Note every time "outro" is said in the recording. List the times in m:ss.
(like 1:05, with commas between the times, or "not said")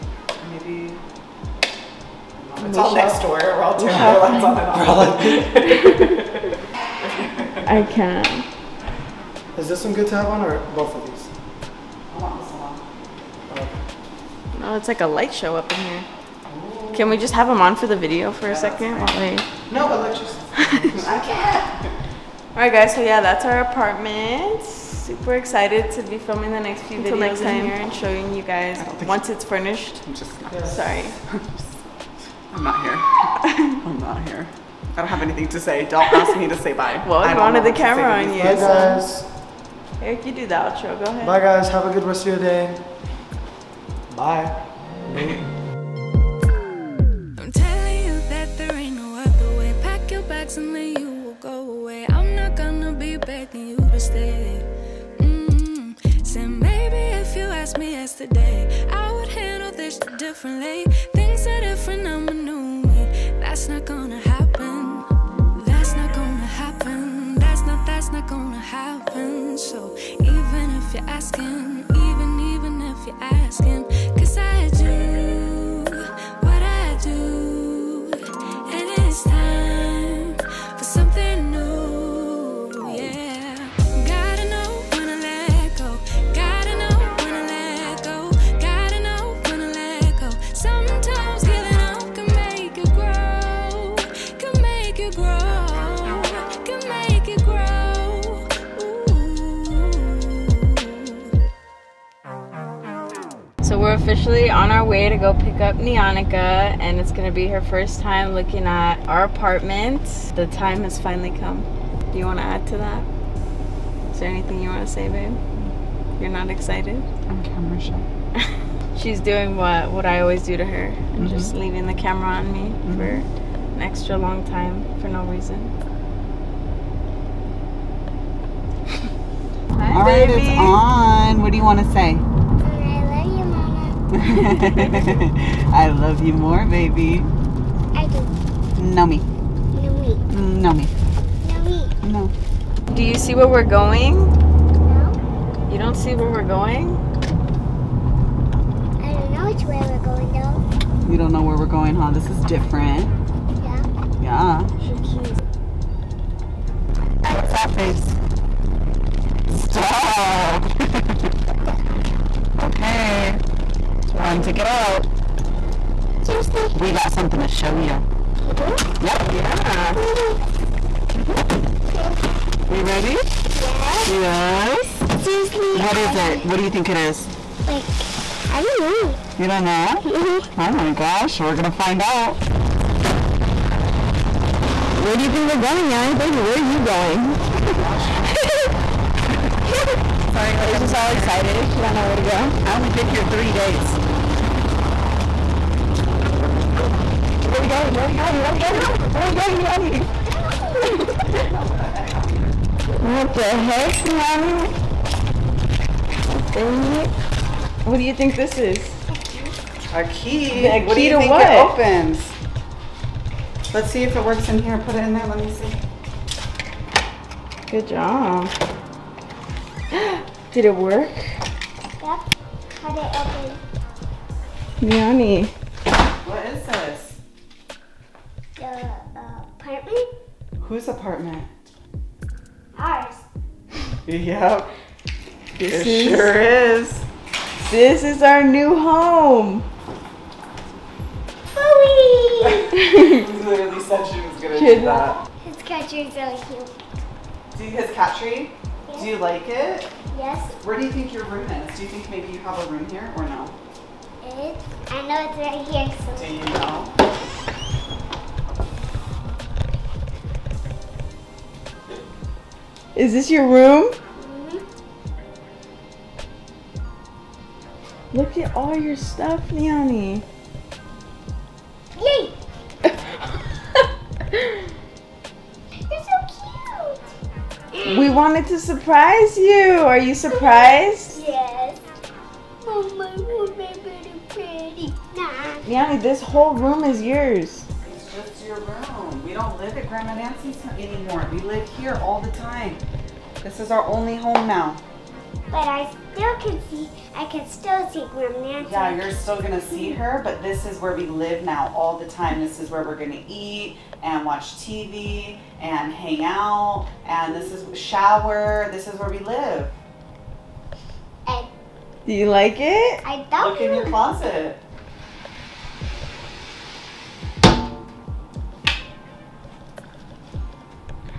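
0:40.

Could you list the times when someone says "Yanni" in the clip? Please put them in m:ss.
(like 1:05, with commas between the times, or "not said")
3:19, 3:24, 3:44.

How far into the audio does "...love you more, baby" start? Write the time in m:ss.
2:15.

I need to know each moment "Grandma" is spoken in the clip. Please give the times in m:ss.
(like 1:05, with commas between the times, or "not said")
4:49, 4:58.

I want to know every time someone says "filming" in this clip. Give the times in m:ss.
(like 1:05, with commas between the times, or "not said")
0:26.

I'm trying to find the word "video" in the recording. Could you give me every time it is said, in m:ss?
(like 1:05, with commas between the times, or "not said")
0:17, 0:27.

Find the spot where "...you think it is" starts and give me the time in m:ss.
2:56.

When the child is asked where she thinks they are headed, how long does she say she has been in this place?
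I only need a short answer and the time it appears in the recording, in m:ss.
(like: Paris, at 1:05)
3 days, at 3:13.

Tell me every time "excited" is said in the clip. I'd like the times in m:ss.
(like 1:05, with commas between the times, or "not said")
0:25, 1:56, 3:11.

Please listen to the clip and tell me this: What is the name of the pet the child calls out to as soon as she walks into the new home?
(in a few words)
Bowie.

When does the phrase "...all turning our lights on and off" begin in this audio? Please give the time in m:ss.
0:03.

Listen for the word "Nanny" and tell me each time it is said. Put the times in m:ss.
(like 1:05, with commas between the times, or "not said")
3:05.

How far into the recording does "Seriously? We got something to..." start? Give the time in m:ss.
2:46.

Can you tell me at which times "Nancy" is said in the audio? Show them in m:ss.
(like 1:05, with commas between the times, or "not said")
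4:50, 4:58.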